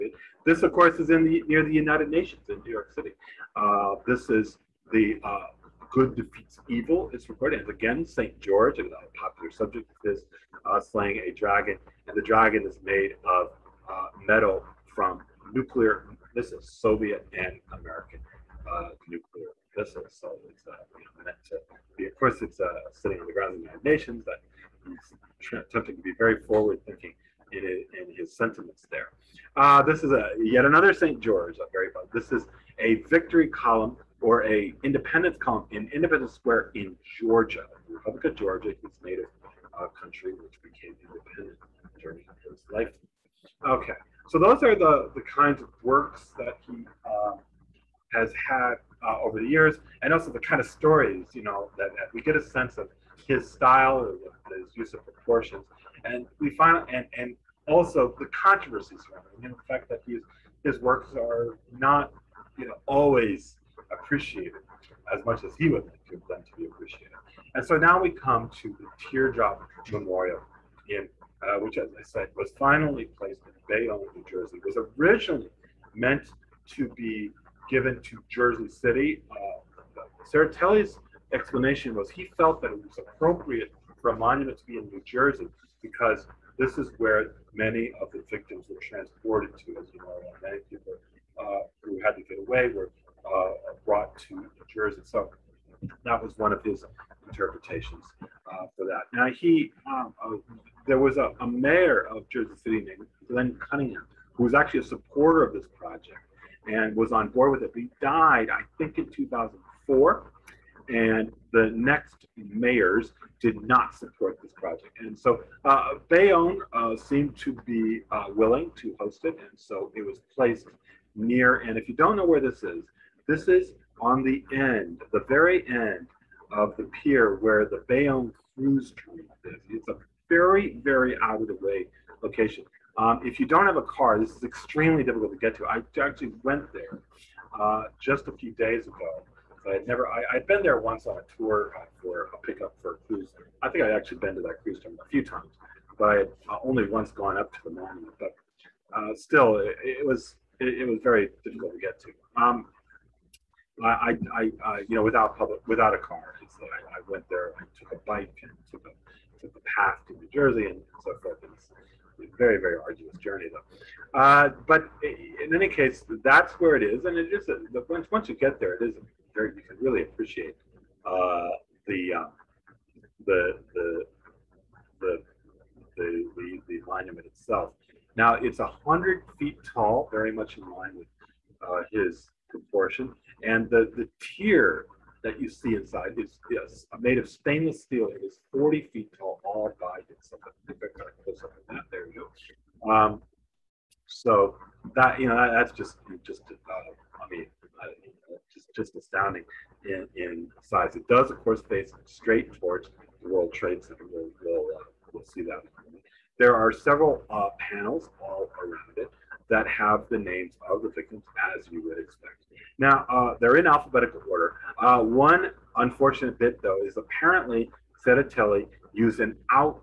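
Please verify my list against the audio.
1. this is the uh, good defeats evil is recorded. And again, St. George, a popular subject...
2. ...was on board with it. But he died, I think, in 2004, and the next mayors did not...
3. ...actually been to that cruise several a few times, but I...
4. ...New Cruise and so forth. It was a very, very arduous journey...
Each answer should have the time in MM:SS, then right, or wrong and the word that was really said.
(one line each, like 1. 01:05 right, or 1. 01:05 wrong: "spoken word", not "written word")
1. 00:04 right
2. 01:46 right
3. 02:23 wrong: "terminal", not "several"
4. 02:40 wrong: "Jersey", not "Cruise".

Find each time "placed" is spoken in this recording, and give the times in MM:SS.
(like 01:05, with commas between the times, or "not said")
01:13, 02:00.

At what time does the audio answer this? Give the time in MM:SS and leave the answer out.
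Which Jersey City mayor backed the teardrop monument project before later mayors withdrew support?
01:43.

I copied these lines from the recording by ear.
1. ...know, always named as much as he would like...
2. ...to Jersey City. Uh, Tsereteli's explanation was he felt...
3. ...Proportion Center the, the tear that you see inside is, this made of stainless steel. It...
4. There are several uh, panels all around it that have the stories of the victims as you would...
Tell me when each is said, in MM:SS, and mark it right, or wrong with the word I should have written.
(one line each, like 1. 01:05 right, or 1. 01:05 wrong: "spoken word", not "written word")
1. 01:02 wrong: "appreciated", not "named"
2. 01:18 right
3. 03:02 wrong: "And", not "Center"
4. 03:26 wrong: "names", not "stories".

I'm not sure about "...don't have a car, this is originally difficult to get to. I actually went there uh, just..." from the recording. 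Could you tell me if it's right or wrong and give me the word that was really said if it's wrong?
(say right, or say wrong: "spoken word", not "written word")
wrong: "extremely", not "originally".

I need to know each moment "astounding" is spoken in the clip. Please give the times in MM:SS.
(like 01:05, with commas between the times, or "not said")
03:18.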